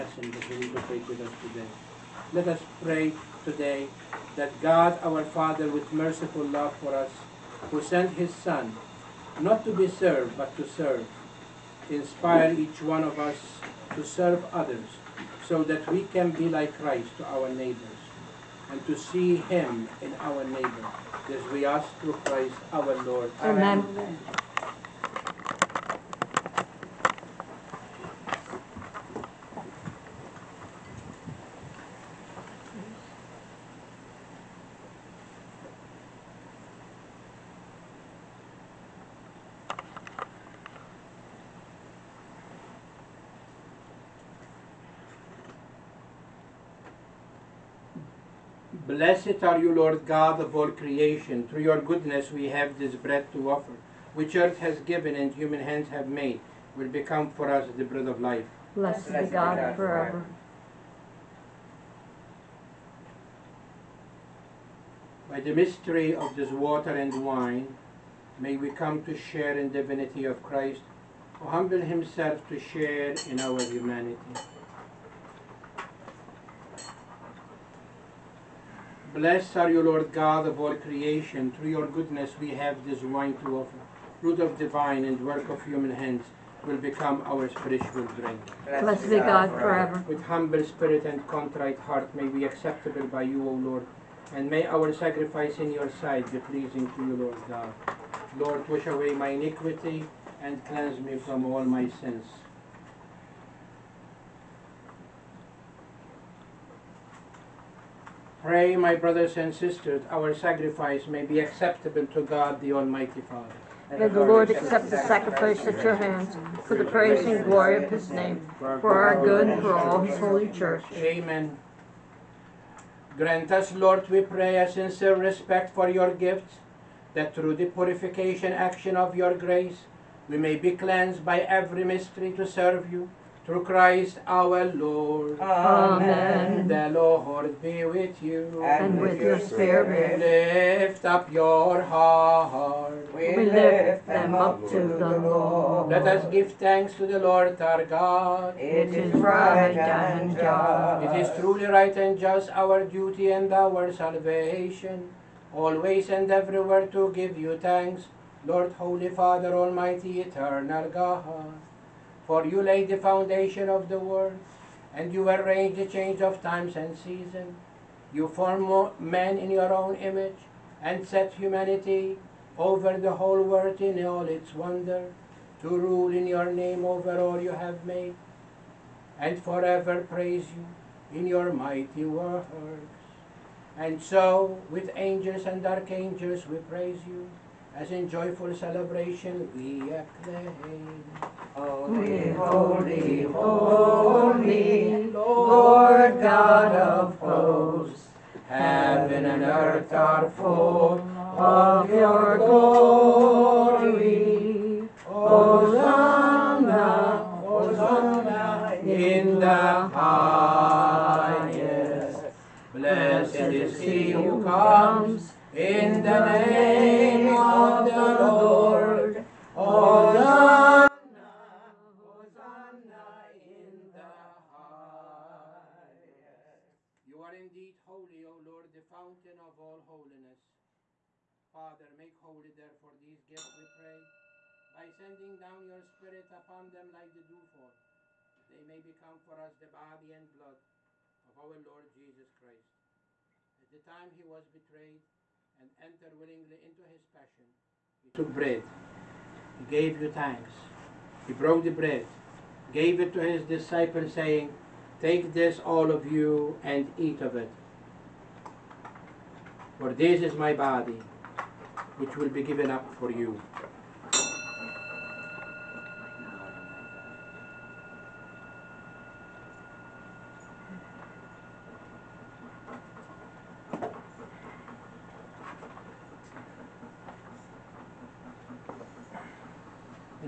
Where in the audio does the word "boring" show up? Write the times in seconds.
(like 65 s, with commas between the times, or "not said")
not said.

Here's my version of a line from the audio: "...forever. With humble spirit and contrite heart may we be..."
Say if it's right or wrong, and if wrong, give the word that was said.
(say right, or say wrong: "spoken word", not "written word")
right.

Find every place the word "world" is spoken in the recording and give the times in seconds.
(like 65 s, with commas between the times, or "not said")
163 s, 173 s.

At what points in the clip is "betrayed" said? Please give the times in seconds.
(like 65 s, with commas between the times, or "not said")
244 s.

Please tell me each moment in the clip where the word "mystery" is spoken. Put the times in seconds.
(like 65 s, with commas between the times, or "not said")
65 s, 131 s.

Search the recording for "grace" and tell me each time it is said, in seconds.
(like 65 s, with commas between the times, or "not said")
129 s.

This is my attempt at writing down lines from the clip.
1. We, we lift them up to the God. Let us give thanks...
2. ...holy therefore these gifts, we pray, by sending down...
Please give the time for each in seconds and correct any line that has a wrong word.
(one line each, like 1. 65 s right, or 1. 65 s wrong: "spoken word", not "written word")
1. 143 s wrong: "Lord", not "God"
2. 232 s right.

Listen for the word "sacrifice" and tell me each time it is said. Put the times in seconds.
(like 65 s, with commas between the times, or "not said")
94 s, 110 s, 114 s.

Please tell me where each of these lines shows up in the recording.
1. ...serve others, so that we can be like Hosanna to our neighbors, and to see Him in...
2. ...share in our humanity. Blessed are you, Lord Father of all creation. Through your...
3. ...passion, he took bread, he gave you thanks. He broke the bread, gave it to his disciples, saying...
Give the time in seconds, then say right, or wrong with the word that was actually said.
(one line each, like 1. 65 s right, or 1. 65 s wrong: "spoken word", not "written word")
1. 14 s wrong: "Christ", not "Hosanna"
2. 72 s wrong: "God", not "Father"
3. 247 s right.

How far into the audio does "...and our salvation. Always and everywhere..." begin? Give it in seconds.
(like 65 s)
153 s.